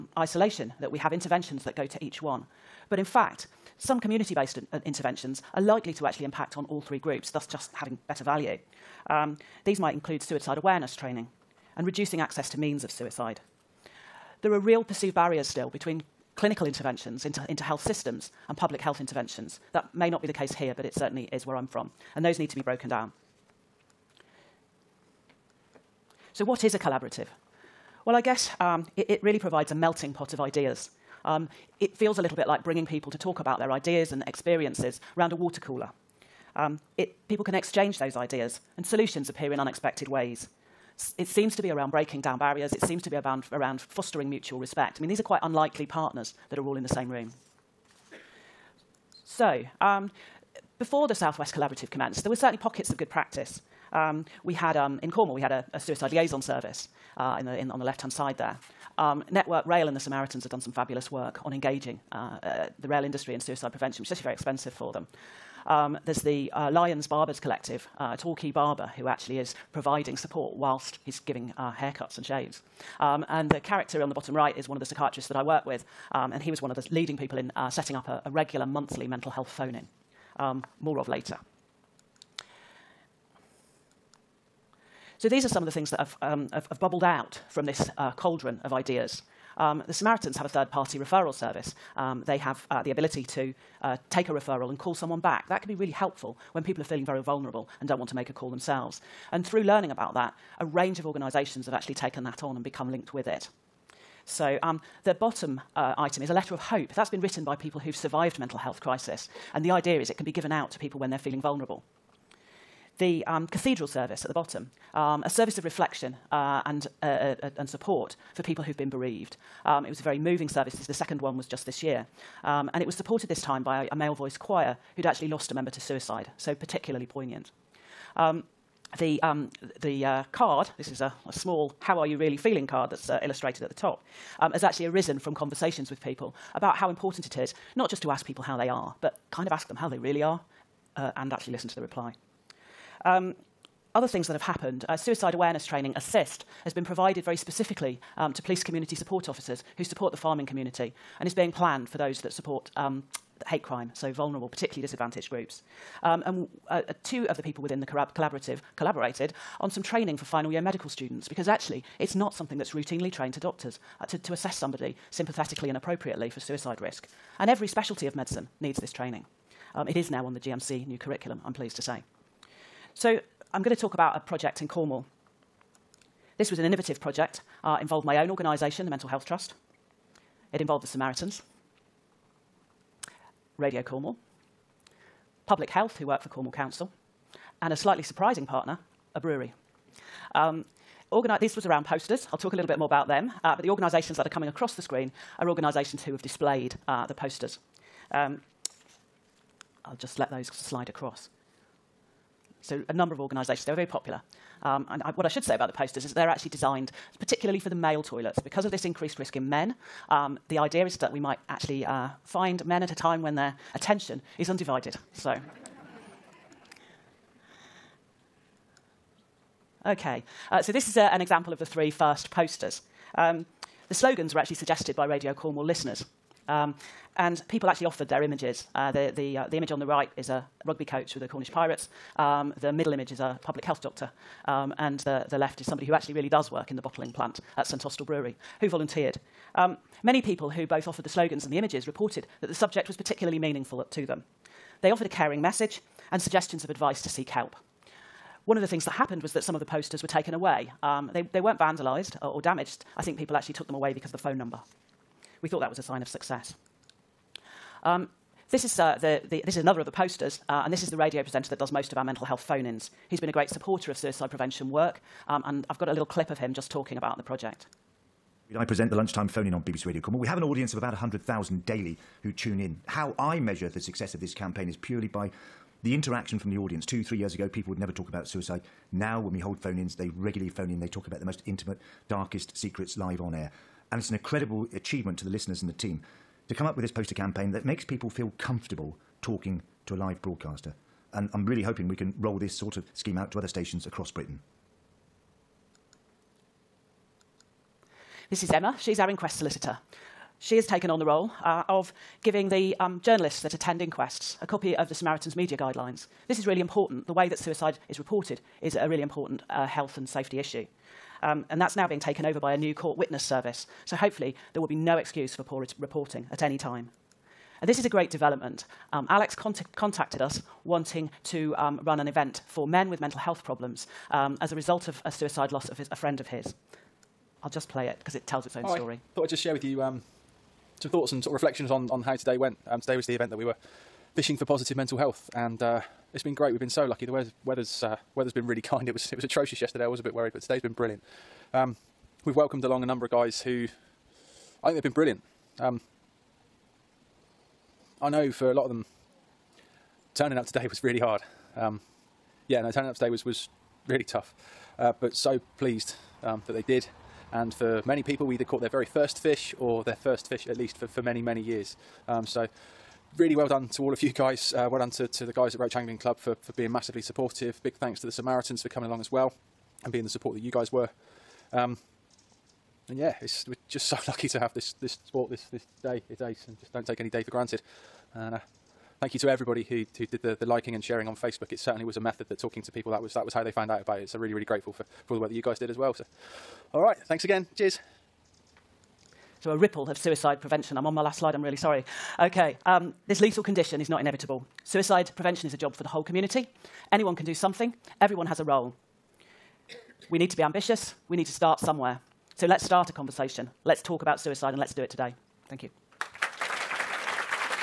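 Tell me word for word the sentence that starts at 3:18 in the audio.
Um, I'll just let those slide across.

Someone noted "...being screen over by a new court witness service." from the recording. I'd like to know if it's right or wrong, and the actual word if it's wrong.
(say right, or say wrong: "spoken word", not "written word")
wrong: "taken", not "screen".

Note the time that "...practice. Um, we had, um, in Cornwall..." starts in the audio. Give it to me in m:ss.
0:53.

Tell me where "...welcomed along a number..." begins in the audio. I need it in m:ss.
5:42.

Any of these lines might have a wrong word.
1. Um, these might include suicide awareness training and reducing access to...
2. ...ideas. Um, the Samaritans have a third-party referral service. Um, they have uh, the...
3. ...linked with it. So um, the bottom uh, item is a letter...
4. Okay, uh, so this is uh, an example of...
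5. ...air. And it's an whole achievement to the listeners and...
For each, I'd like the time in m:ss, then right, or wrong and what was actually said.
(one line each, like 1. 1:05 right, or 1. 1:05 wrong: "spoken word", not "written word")
1. 0:09 right
2. 1:28 right
3. 1:42 right
4. 3:39 right
5. 4:43 wrong: "incredible", not "whole".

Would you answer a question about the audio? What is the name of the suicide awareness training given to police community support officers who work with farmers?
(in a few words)
ASSIST.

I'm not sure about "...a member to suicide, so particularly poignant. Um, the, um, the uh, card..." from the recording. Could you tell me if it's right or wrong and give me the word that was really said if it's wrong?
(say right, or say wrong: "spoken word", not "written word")
right.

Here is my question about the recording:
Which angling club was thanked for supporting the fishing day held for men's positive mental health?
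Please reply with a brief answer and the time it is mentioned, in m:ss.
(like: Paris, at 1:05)
Roche Angling Club, at 6:05.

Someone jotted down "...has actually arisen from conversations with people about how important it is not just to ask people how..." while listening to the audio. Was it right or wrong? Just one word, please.
right.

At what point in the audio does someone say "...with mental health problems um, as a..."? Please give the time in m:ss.
5:22.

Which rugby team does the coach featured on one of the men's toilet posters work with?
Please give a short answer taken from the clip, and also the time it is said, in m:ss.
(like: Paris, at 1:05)
Cornish Pirates, at 3:51.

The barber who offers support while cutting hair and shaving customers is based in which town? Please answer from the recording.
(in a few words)
Torquay.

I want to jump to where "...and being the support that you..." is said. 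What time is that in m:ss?
6:09.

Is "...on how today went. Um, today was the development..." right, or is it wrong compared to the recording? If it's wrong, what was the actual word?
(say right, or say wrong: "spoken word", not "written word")
wrong: "event", not "development".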